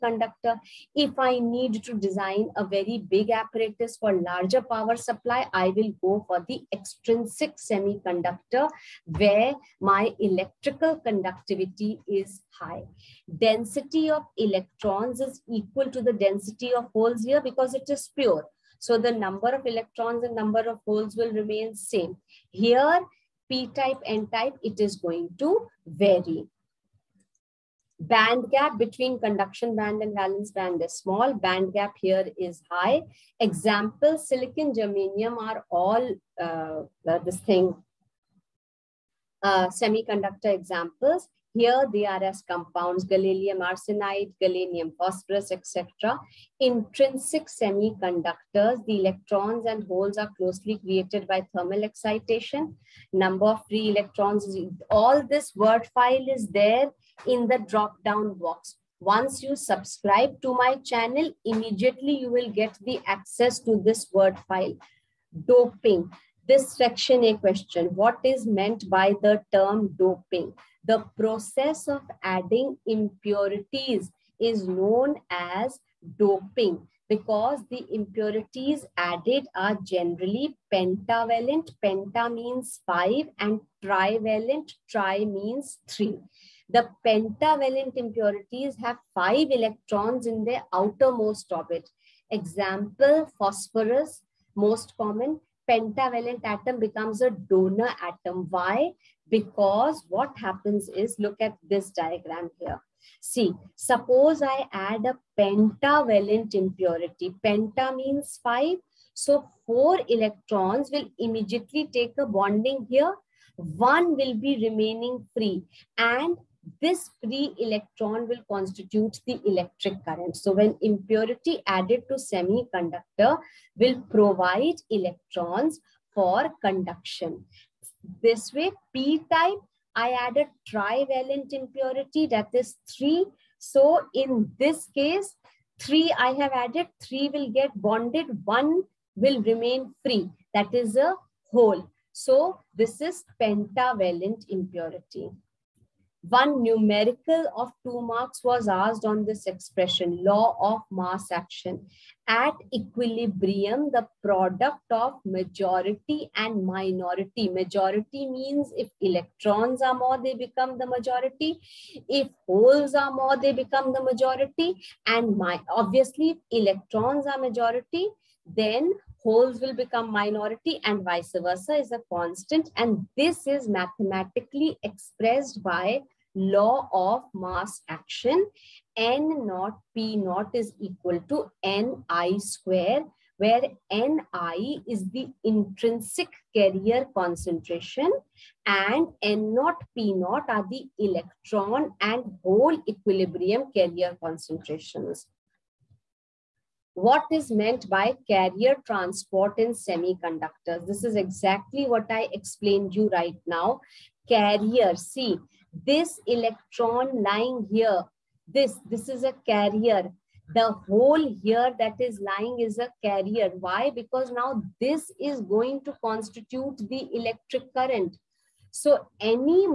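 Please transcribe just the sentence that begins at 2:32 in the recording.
At equilibrium, the product of majority and minority.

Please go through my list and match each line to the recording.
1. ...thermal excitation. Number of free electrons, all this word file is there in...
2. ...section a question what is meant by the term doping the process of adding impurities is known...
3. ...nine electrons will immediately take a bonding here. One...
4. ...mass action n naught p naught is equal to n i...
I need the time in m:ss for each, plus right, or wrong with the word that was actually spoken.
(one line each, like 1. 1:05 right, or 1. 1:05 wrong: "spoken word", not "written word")
1. 0:51 right
2. 1:06 right
3. 1:49 wrong: "four", not "nine"
4. 2:57 right.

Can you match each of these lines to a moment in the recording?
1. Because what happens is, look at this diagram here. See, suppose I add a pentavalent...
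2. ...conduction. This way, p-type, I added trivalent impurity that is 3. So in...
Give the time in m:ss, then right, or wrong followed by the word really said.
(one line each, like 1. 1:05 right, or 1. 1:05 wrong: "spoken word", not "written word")
1. 1:39 right
2. 2:06 right.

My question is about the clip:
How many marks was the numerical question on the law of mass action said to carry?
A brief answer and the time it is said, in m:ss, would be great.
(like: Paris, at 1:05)
2, at 2:27.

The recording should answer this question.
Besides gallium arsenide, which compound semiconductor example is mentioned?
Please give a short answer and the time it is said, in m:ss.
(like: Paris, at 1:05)
Gallium phosphorus, at 0:44.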